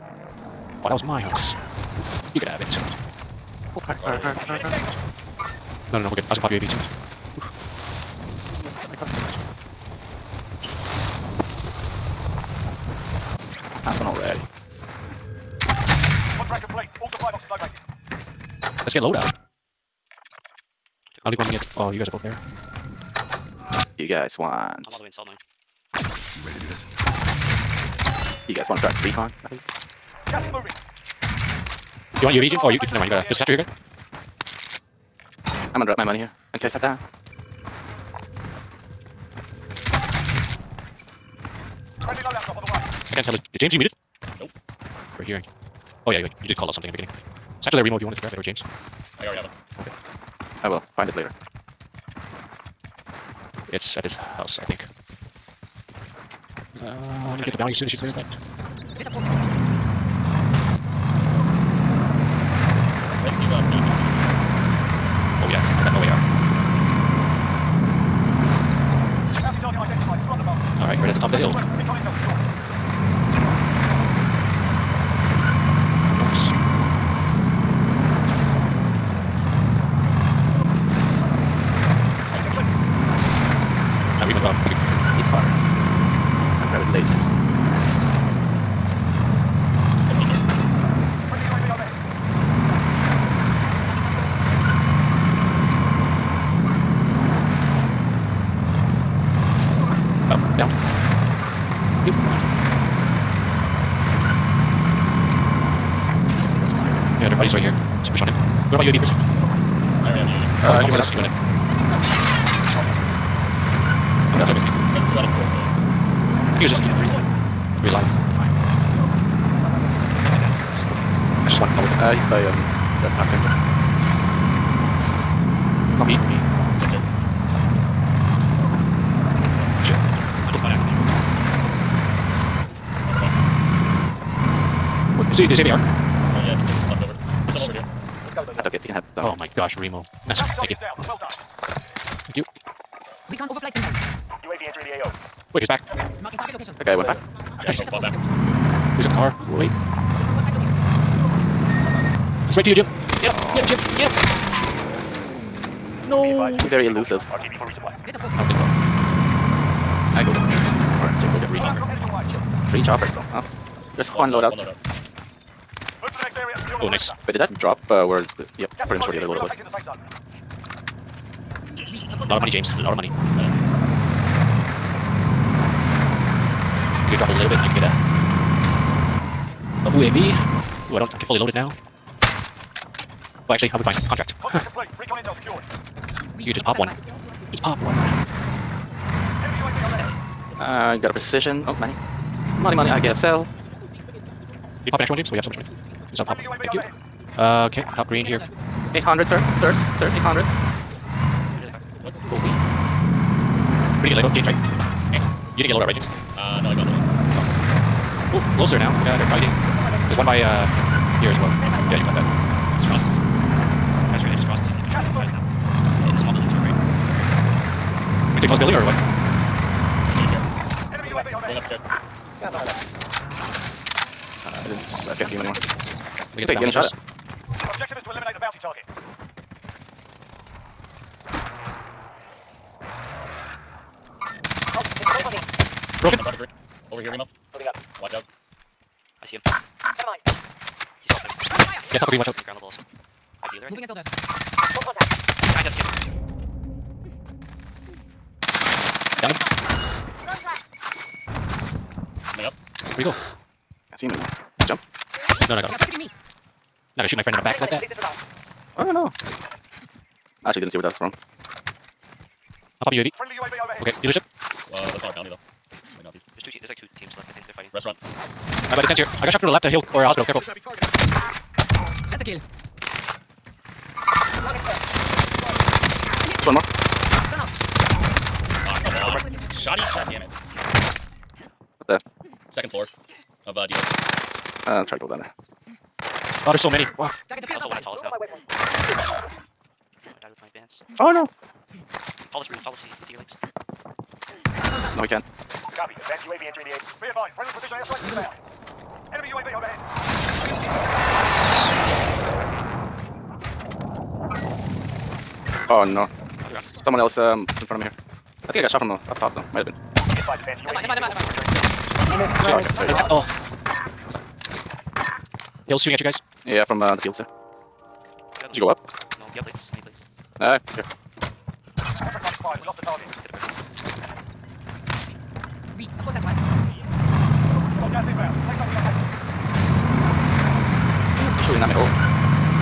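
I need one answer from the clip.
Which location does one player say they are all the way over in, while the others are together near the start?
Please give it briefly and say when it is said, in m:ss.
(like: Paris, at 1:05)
Salt mine, at 0:25.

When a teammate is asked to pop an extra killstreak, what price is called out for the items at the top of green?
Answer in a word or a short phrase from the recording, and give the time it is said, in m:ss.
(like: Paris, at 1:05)
800, at 3:18.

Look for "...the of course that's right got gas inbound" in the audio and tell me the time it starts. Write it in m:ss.
5:23.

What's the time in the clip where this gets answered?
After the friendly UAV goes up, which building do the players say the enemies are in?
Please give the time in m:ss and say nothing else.
4:24.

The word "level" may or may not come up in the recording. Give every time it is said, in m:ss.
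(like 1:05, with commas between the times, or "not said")
4:02.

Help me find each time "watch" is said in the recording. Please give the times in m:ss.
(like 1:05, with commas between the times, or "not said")
3:58, 4:02.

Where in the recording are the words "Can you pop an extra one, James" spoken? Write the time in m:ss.
3:13.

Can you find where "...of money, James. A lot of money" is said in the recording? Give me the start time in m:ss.
2:52.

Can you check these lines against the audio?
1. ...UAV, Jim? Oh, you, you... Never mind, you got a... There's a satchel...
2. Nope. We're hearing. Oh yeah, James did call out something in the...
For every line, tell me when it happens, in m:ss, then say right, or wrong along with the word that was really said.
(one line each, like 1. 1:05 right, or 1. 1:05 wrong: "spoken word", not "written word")
1. 0:32 right
2. 0:44 wrong: "You", not "James".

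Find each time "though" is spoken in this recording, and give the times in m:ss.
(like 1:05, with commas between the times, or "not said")
4:25, 5:09.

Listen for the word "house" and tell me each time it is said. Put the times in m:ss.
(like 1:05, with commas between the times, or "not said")
0:01, 0:54.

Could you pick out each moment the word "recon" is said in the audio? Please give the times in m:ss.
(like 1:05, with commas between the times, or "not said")
0:29, 2:23, 3:04.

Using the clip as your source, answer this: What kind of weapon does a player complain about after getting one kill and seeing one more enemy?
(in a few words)
Shotty.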